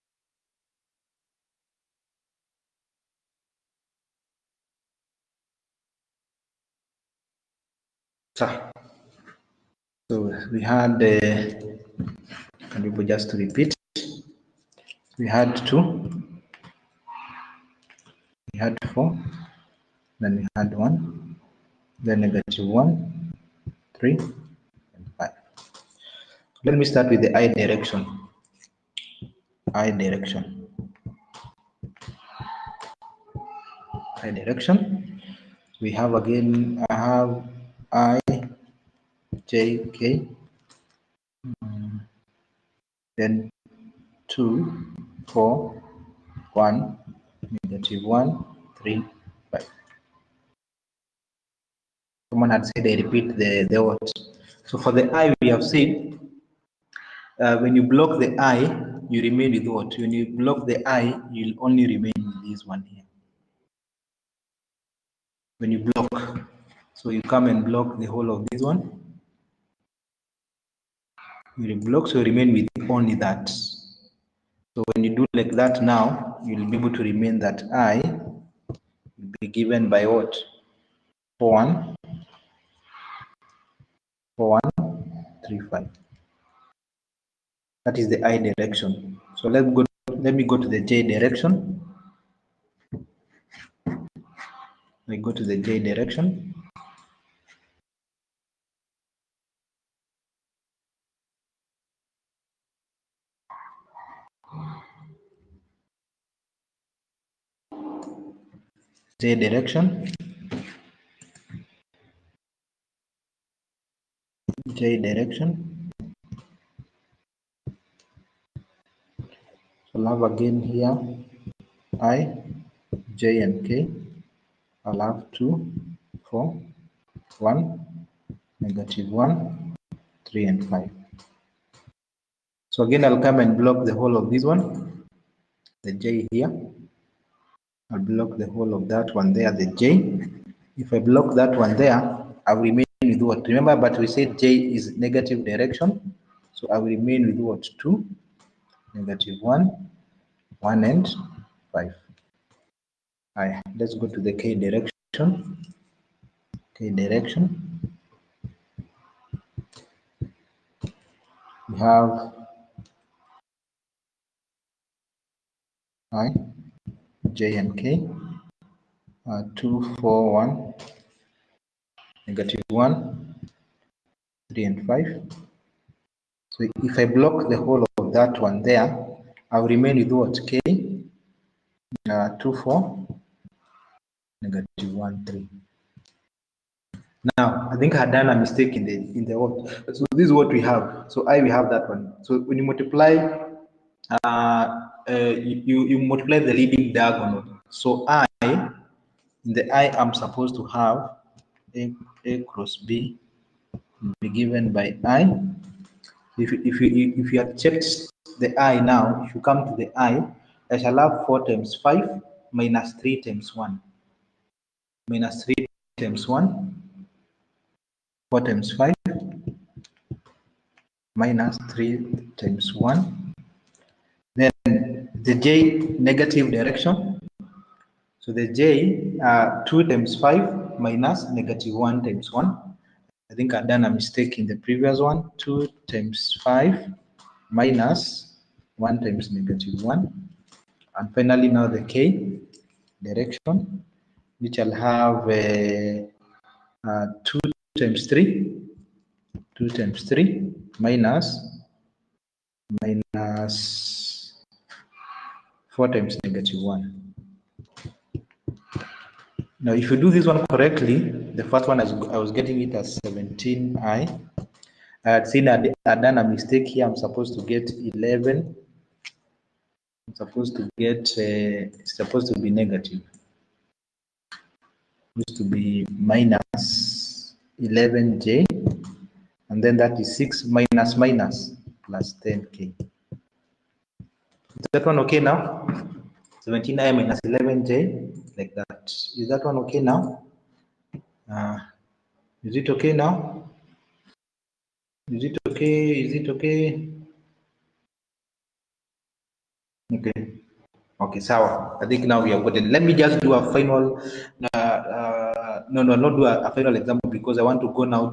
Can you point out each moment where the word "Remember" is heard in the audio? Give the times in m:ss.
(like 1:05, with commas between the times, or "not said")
2:23.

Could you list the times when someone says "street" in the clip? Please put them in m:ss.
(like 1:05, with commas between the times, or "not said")
not said.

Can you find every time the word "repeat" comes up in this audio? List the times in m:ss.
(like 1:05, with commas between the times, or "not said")
0:13, 0:52.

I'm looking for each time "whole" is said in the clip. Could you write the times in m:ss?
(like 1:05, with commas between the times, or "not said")
1:08, 2:13, 2:18, 2:57.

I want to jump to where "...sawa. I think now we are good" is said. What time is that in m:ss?
5:01.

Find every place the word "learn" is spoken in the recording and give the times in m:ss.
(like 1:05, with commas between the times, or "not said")
not said.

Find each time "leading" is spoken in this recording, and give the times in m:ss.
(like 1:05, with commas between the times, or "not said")
3:16.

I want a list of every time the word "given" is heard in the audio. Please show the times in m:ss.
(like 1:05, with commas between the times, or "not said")
1:19, 3:24.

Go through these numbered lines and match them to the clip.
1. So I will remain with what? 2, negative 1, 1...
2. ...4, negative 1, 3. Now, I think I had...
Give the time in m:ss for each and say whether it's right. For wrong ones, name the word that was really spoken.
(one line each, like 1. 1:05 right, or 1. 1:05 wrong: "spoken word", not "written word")
1. 2:26 right
2. 3:02 right.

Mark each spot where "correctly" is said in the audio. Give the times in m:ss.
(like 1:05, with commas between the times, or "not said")
4:20.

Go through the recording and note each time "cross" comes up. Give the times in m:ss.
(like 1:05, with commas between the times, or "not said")
3:22.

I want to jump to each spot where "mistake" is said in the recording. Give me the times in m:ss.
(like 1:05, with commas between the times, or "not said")
3:08, 3:53, 4:26.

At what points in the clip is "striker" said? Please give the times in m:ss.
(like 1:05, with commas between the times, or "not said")
not said.